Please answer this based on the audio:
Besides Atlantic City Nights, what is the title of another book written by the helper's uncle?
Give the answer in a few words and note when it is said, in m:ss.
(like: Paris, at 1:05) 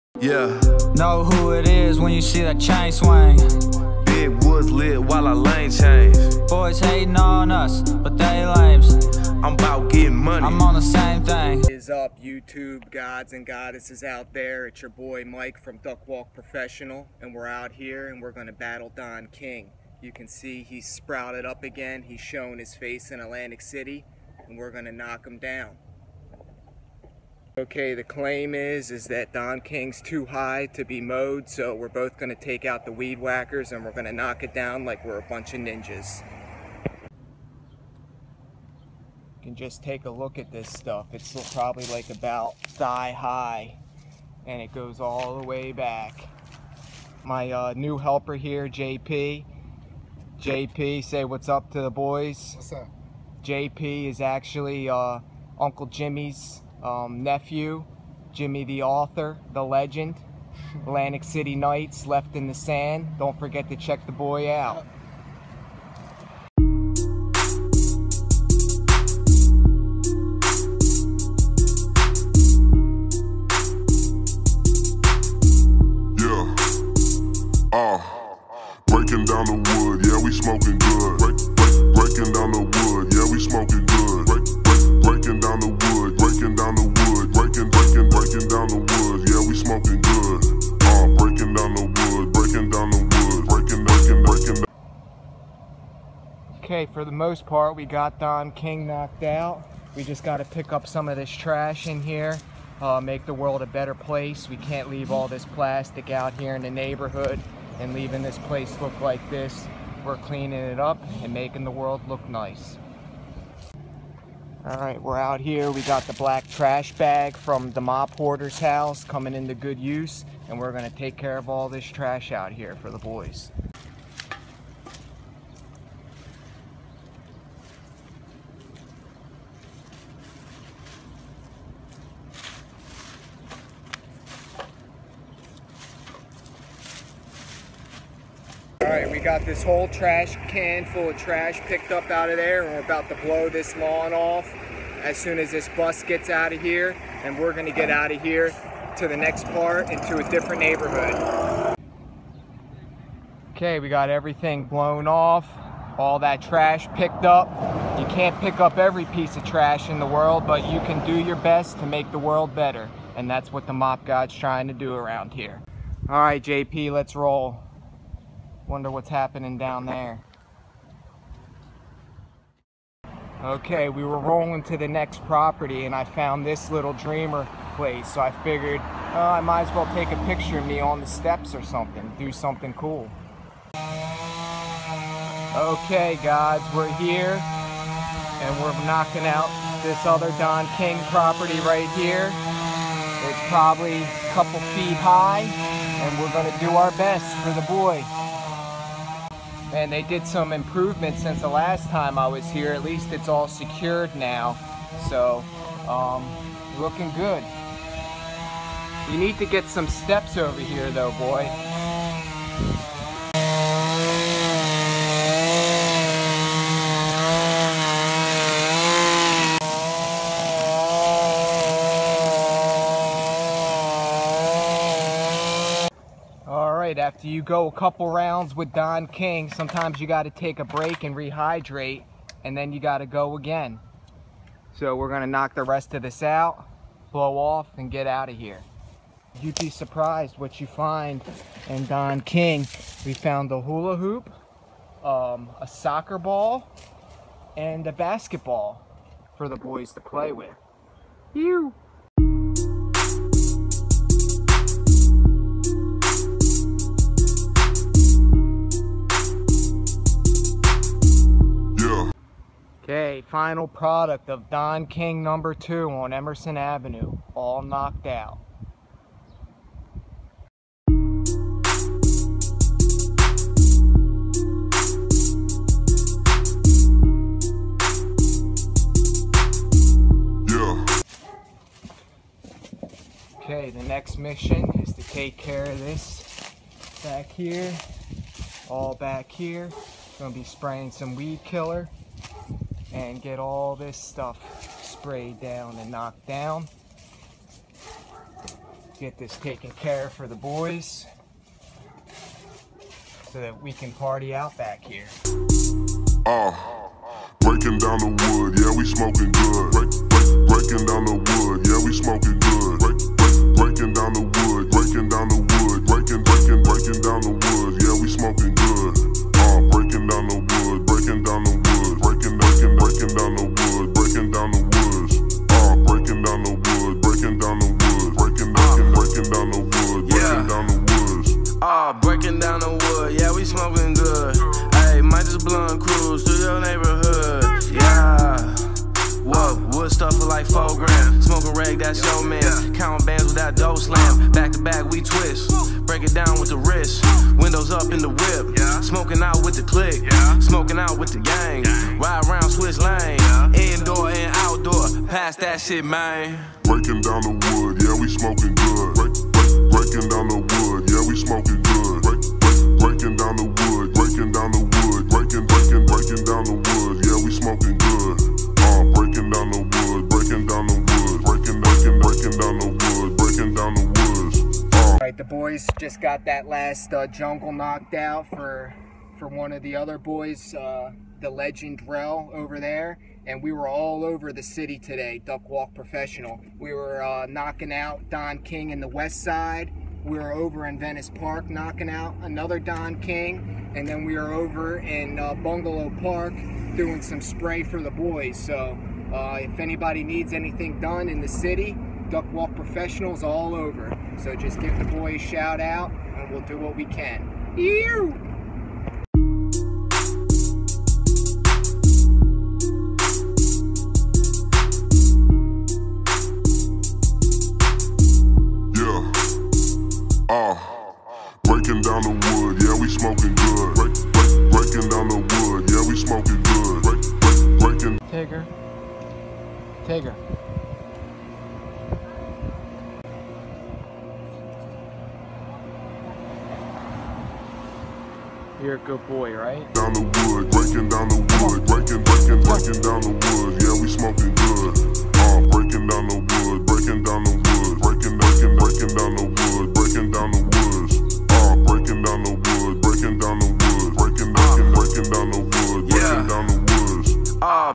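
Left in the Sand, at 1:02.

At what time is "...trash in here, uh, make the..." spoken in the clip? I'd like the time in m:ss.
1:41.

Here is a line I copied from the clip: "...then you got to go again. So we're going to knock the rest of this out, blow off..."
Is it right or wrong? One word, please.
right.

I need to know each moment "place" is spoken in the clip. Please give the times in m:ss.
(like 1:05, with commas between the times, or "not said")
1:43, 1:48, 2:57.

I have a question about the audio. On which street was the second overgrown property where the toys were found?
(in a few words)
Emerson Avenue.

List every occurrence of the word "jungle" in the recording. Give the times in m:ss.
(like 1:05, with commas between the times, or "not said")
6:17.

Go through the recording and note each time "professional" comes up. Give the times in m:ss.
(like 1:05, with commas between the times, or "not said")
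0:16, 6:25, 6:42.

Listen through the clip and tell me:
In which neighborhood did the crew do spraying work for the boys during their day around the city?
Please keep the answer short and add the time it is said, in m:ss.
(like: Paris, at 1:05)
Bungalow Park, at 6:35.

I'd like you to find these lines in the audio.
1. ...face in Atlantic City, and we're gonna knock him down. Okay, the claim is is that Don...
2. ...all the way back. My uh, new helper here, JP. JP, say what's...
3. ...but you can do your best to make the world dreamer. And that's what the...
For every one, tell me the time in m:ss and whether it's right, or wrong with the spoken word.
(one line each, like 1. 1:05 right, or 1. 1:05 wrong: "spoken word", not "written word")
1. 0:22 right
2. 0:44 right
3. 2:40 wrong: "better", not "dreamer".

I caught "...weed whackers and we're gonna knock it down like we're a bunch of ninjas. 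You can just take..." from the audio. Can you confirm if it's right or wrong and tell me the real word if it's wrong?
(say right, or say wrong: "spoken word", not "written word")
right.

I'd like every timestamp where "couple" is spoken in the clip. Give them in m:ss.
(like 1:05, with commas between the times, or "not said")
3:14, 3:47.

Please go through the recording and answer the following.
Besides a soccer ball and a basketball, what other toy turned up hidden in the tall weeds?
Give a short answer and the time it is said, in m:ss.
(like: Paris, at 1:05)
hula hoop, at 4:03.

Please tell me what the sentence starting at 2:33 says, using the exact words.
Okay, we got everything blown off, all that trash picked up.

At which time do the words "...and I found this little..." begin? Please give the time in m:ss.
2:55.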